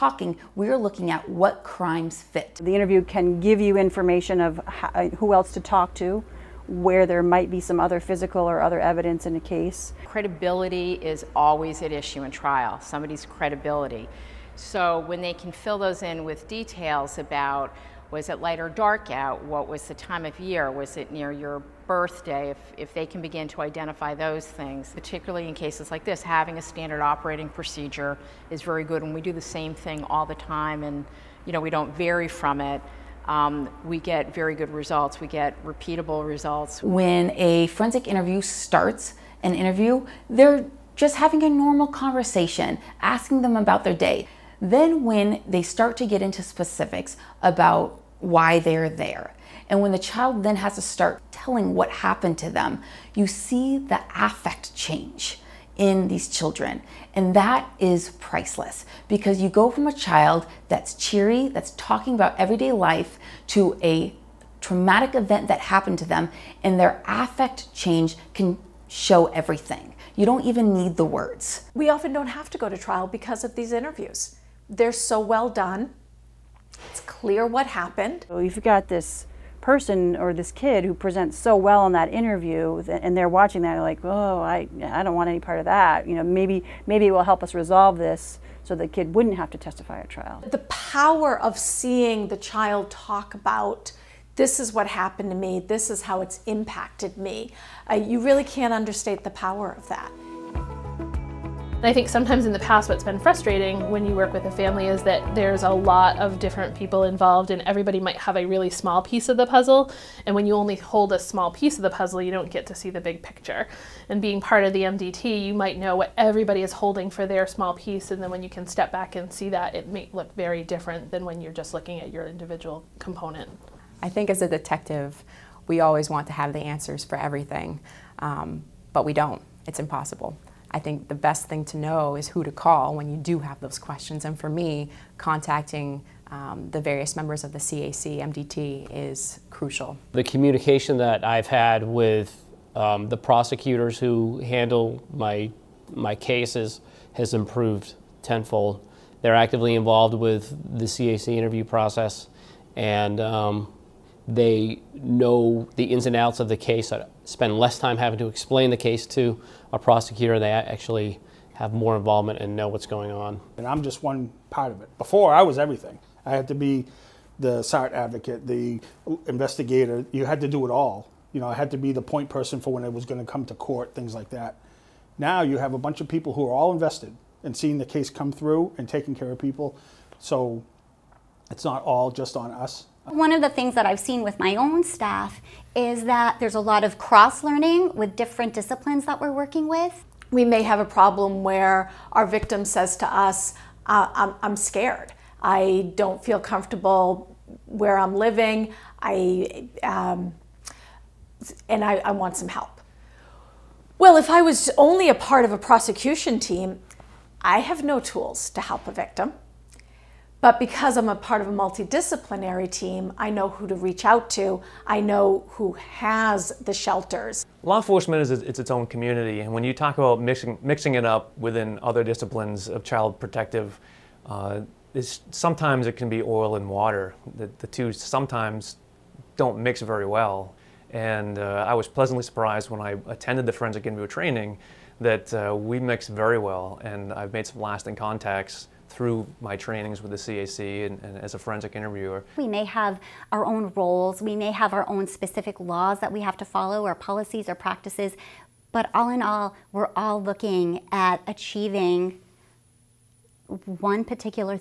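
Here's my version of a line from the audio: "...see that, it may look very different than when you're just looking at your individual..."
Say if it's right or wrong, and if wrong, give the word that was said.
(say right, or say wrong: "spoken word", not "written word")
right.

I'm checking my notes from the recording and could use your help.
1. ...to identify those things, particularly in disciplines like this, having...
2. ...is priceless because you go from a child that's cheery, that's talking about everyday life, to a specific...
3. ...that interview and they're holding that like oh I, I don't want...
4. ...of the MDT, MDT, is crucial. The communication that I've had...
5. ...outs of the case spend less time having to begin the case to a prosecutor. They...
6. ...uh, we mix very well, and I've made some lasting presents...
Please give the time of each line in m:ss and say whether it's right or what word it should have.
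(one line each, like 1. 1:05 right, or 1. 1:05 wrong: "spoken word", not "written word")
1. 0:23 wrong: "cases", not "disciplines"
2. 0:57 wrong: "traumatic", not "specific"
3. 1:21 wrong: "watching", not "holding"
4. 2:17 wrong: "CAC", not "MDT"
5. 2:36 wrong: "explain", not "begin"
6. 3:55 wrong: "contacts", not "presents".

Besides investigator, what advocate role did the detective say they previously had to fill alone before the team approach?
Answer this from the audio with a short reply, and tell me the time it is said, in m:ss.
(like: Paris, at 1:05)
SART advocate, at 2:47.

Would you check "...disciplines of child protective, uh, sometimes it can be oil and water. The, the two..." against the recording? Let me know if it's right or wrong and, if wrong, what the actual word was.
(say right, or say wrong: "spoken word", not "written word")
right.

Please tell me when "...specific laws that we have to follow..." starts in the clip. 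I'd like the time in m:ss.
4:05.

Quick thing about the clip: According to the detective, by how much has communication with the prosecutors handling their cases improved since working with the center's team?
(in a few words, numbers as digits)
tenfold.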